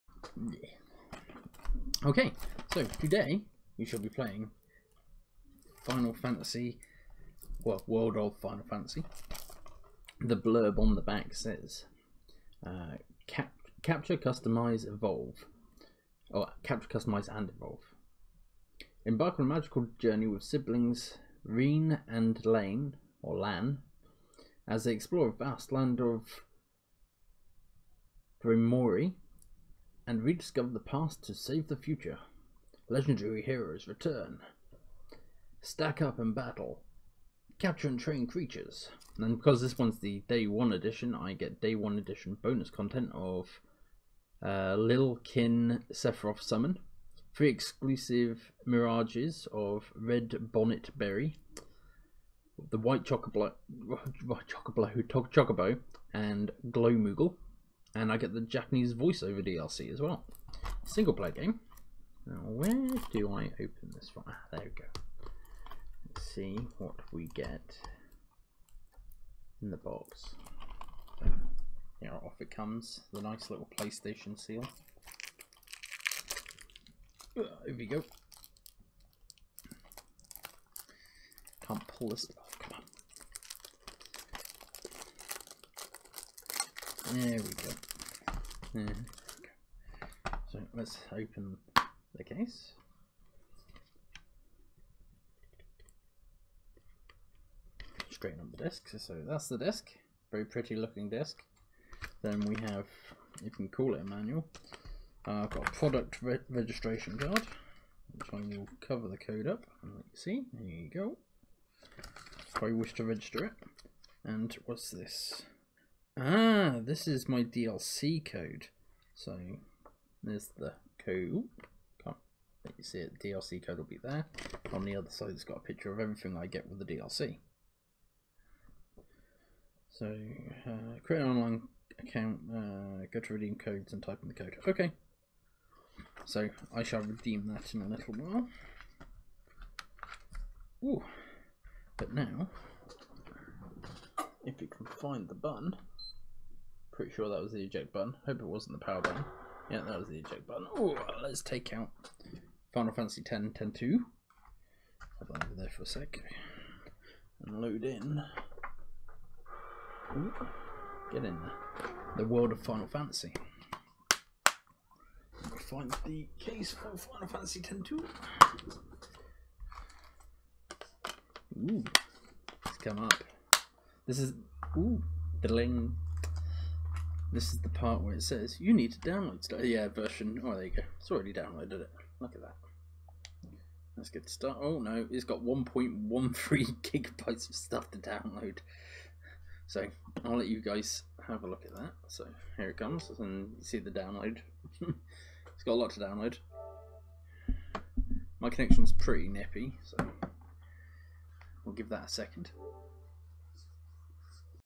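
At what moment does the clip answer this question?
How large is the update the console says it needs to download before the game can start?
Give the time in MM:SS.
03:05.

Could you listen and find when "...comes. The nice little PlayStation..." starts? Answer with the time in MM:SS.
01:12.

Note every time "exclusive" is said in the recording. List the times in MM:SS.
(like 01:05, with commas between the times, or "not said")
00:47.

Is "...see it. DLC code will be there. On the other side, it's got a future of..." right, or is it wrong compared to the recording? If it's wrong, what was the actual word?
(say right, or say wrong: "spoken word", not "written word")
wrong: "picture", not "future".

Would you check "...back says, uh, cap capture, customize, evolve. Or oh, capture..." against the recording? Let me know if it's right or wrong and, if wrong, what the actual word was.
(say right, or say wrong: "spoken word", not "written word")
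right.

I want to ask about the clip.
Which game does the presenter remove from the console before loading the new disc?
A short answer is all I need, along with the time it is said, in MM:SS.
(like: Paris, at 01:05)
Final Fantasy 10-2, at 02:32.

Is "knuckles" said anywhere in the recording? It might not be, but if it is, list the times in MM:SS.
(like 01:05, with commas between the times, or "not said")
not said.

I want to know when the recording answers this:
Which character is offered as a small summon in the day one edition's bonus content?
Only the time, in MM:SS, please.
00:45.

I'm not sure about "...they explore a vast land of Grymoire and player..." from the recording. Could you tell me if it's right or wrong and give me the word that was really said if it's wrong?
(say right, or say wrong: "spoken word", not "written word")
wrong: "rediscover", not "player".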